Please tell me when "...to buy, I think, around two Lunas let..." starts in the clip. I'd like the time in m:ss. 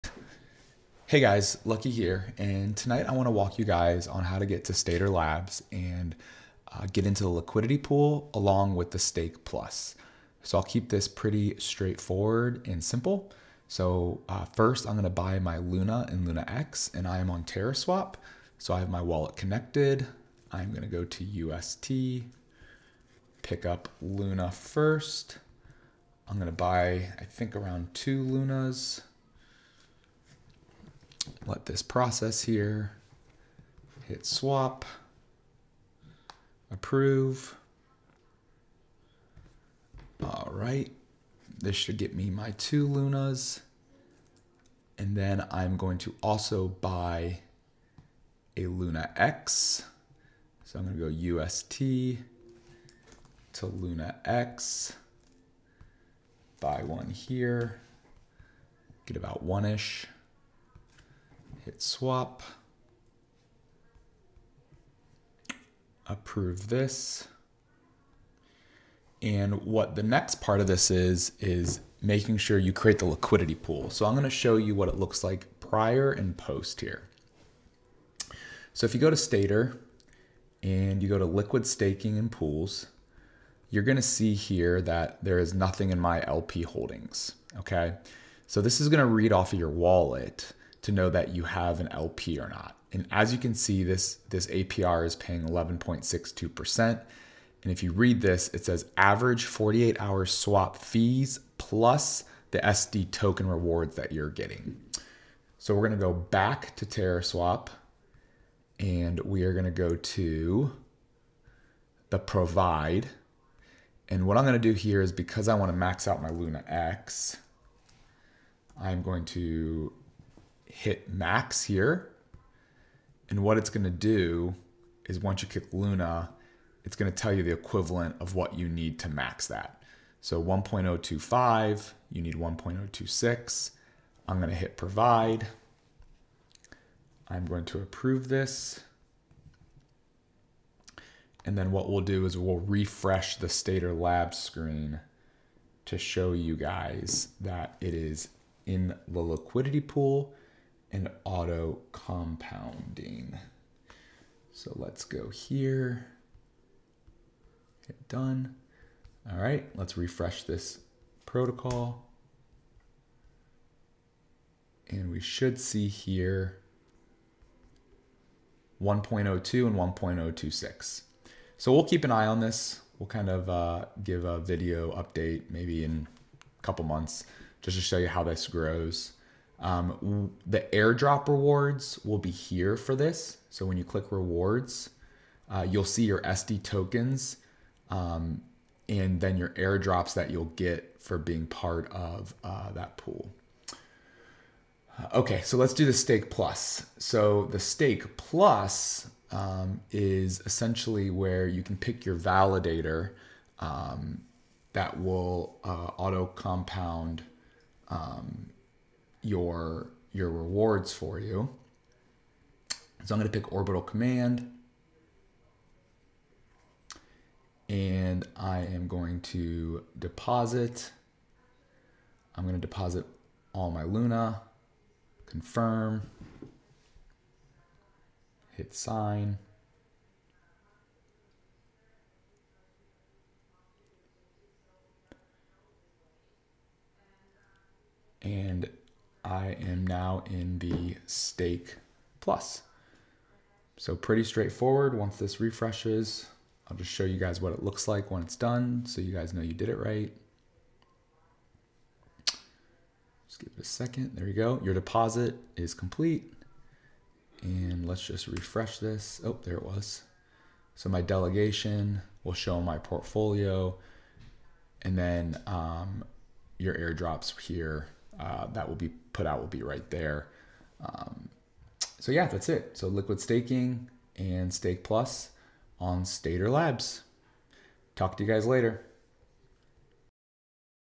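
0:26.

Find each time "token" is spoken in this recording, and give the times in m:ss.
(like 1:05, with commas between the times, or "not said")
1:43, 3:06.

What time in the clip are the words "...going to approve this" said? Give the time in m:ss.
2:17.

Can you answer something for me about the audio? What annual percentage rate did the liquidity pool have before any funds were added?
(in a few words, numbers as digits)
11.62%.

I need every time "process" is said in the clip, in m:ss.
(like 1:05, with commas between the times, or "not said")
0:31.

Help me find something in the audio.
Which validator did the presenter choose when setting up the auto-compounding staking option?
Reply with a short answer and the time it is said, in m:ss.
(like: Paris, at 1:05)
Orbital Command, at 3:33.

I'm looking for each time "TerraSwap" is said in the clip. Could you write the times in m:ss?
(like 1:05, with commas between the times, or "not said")
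0:17, 1:46.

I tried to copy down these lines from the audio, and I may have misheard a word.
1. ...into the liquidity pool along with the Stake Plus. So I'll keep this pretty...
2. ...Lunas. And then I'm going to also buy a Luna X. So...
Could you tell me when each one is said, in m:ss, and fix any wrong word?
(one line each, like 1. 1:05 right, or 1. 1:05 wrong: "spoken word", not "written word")
1. 0:07 right
2. 0:42 right.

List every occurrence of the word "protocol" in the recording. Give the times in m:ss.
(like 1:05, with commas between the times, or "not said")
2:41.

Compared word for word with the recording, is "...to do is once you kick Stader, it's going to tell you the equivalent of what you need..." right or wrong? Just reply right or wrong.
wrong.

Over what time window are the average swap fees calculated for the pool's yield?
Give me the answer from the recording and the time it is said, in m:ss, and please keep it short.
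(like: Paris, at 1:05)
48 hours, at 1:39.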